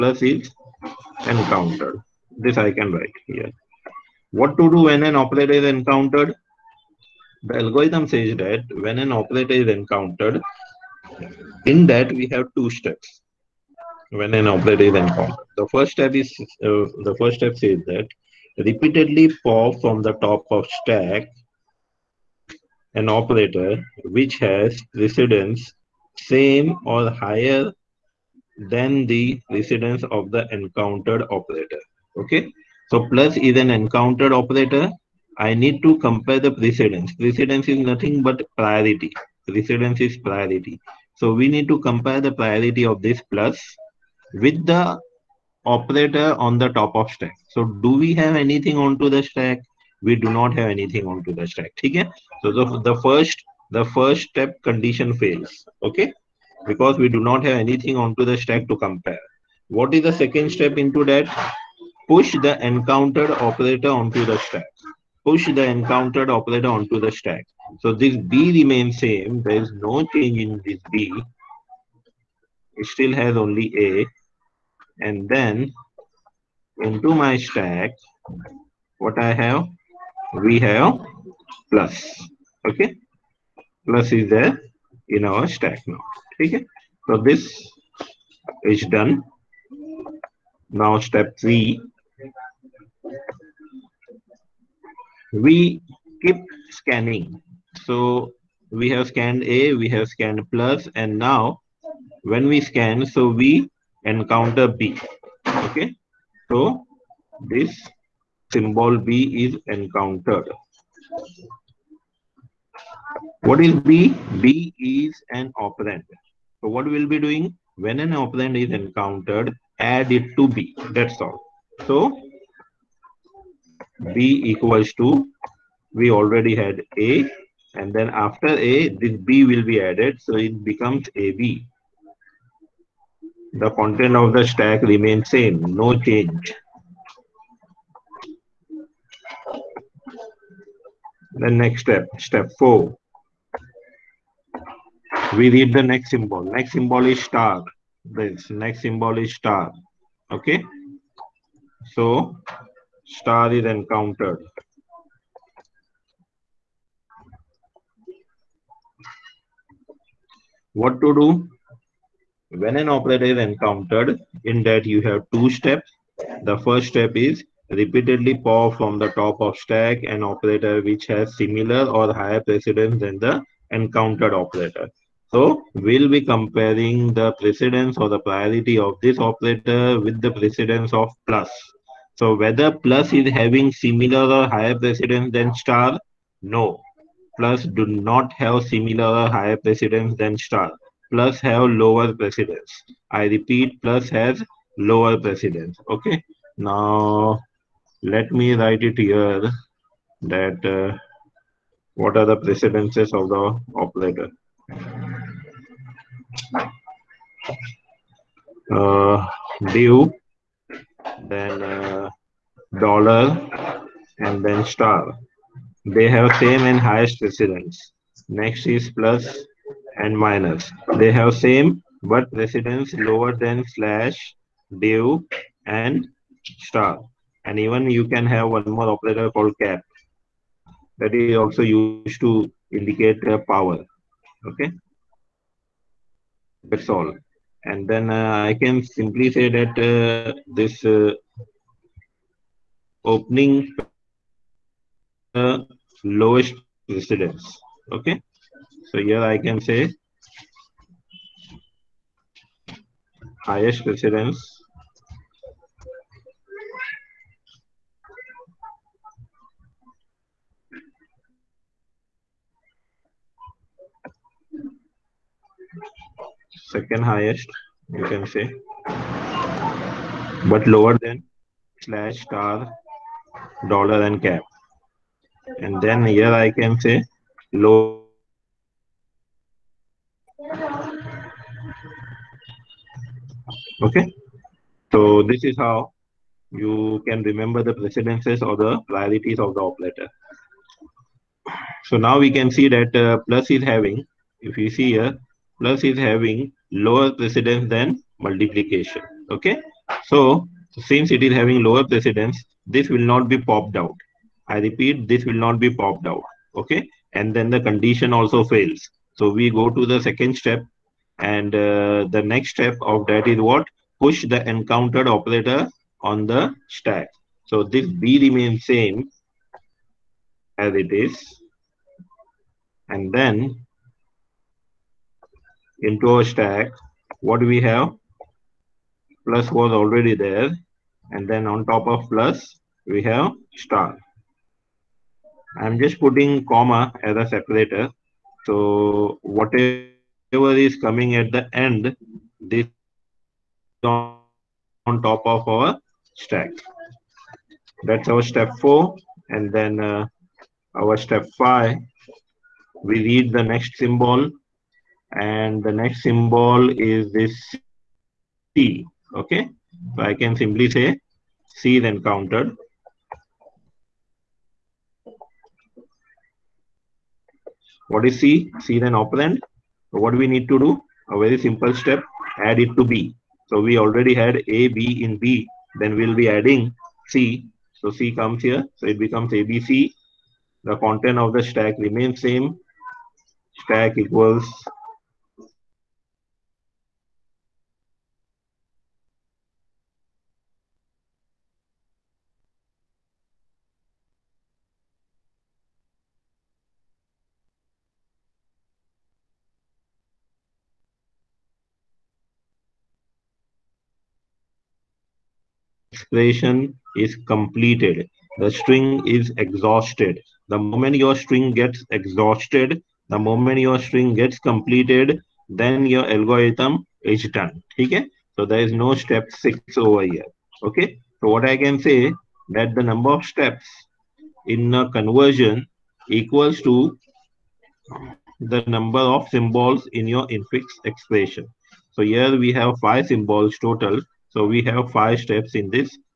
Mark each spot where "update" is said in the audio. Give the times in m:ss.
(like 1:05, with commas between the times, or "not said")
not said.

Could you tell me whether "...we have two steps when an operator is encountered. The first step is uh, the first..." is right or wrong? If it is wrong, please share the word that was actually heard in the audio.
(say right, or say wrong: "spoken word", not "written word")
right.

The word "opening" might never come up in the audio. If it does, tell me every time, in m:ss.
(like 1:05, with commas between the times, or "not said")
4:03.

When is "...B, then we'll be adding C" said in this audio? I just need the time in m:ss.
6:15.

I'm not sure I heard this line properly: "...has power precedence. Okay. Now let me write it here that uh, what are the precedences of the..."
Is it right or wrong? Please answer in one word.
wrong.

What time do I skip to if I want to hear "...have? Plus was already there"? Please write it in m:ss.
5:27.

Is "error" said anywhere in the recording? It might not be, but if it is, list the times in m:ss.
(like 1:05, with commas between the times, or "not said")
not said.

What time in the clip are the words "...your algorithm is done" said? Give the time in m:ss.
6:55.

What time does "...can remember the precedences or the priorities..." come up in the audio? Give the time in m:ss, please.
4:47.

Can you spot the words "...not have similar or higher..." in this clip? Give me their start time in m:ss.
3:07.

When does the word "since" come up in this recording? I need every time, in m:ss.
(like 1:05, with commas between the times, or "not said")
5:00.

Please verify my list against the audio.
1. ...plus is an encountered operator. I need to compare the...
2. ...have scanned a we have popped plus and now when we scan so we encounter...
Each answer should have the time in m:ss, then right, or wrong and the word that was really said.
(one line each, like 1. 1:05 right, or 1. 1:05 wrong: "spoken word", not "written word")
1. 0:33 right
2. 1:38 wrong: "scanned", not "popped".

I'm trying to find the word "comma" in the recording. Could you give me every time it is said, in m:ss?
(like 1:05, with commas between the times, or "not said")
5:36.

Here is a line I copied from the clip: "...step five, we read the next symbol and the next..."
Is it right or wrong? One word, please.
right.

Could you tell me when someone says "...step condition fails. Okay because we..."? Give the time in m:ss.
0:54.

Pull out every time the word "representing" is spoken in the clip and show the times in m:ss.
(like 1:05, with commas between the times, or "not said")
not said.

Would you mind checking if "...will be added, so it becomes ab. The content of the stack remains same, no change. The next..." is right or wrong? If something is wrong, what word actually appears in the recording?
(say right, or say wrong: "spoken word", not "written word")
right.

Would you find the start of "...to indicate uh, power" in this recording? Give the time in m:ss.
3:52.